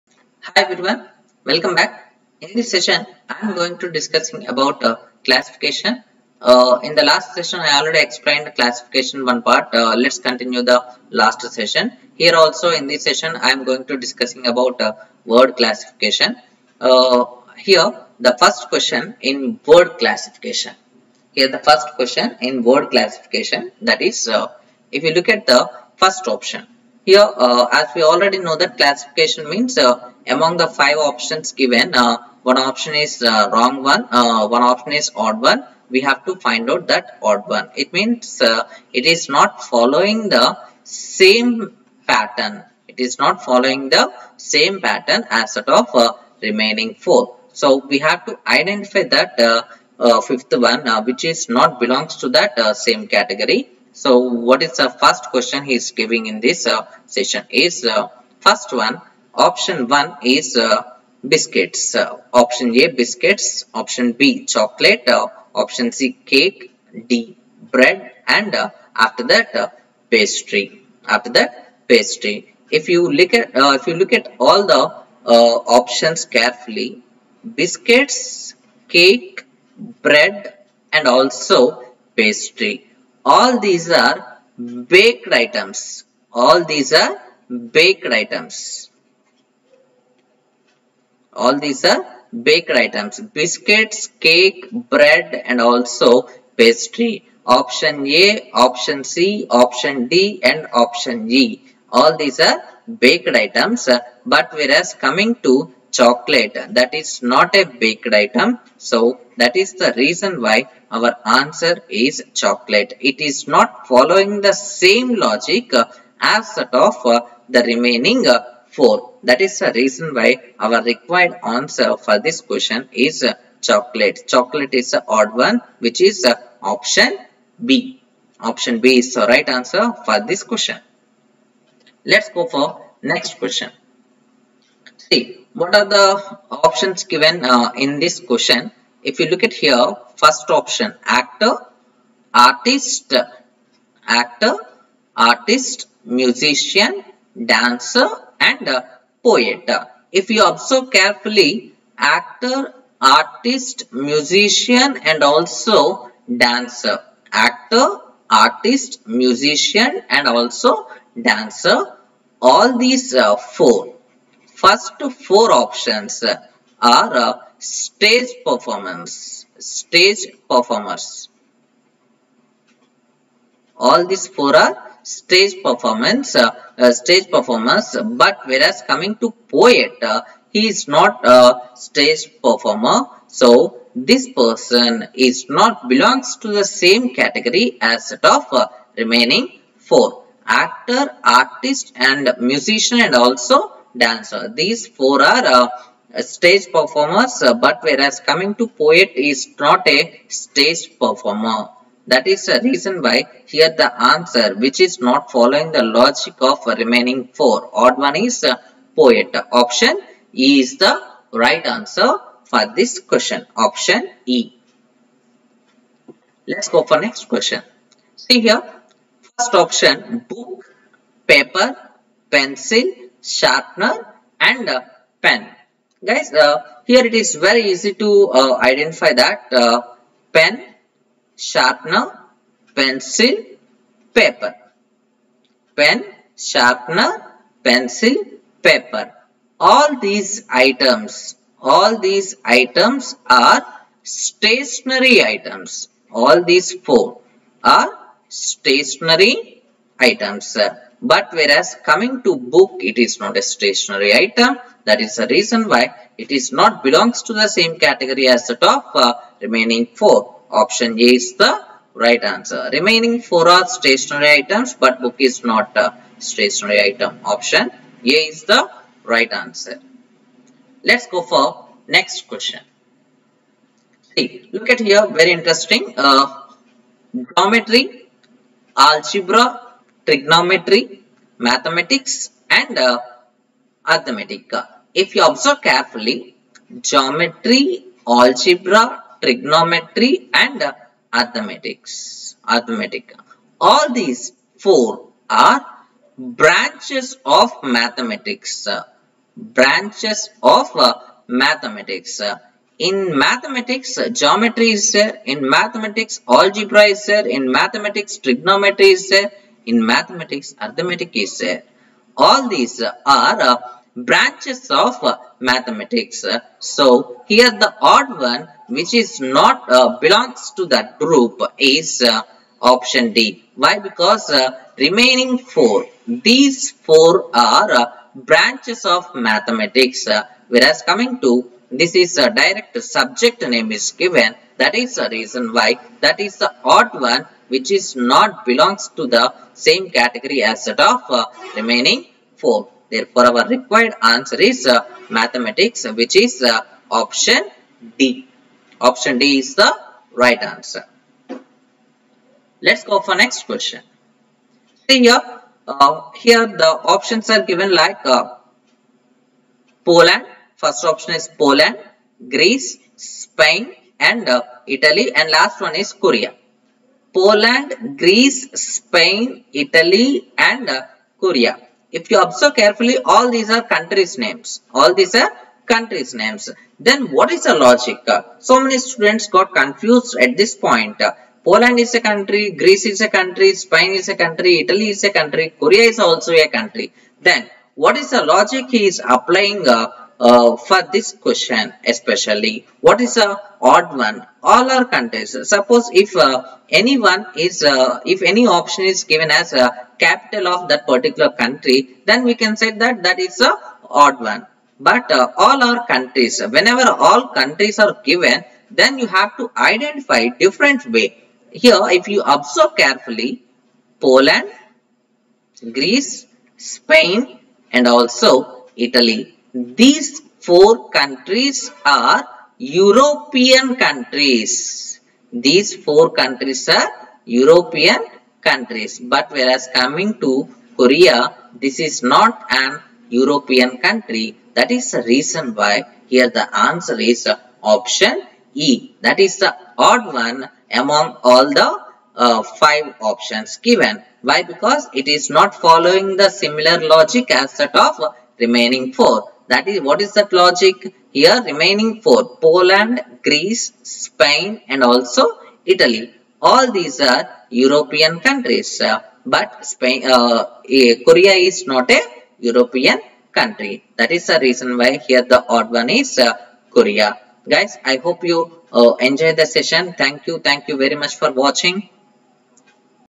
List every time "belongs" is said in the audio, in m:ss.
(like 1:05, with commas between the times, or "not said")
0:51, 3:05, 4:16, 5:19, 5:38.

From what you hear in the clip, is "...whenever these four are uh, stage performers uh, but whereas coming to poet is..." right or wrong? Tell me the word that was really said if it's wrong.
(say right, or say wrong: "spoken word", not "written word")
wrong: "dancer", not "whenever".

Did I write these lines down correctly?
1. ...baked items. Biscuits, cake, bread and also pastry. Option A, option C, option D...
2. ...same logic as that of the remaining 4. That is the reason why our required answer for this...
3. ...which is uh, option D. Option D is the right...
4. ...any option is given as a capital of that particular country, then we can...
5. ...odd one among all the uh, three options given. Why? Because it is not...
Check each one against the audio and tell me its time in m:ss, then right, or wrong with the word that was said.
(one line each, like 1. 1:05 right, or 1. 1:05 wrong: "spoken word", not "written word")
1. 1:32 right
2. 1:54 right
3. 5:45 right
4. 6:38 right
5. 7:19 wrong: "five", not "three".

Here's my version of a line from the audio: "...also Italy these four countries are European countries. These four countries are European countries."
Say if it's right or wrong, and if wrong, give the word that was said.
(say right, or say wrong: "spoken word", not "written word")
right.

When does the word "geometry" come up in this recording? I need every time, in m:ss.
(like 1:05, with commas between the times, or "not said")
4:37, 4:46, 5:04.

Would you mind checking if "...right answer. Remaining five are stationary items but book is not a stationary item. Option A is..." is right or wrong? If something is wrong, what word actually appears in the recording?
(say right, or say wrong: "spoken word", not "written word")
wrong: "four", not "five".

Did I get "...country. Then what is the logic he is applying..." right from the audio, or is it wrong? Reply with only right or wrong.
right.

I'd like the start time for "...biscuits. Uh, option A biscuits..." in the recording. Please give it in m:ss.
1:01.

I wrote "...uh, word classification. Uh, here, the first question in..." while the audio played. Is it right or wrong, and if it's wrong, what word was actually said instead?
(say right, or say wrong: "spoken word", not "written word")
right.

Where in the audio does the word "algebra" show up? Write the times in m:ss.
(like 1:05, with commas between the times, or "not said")
4:38, 4:48, 5:06.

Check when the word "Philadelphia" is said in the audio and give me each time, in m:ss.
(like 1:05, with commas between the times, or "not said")
not said.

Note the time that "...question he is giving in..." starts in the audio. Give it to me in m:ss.
0:55.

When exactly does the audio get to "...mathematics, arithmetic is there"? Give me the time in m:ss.
5:09.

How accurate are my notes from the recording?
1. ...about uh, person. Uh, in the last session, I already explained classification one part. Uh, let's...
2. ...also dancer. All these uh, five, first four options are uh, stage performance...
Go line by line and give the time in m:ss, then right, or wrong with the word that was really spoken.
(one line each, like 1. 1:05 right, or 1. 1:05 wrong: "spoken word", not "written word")
1. 0:04 wrong: "classification", not "person"
2. 2:40 wrong: "four", not "five".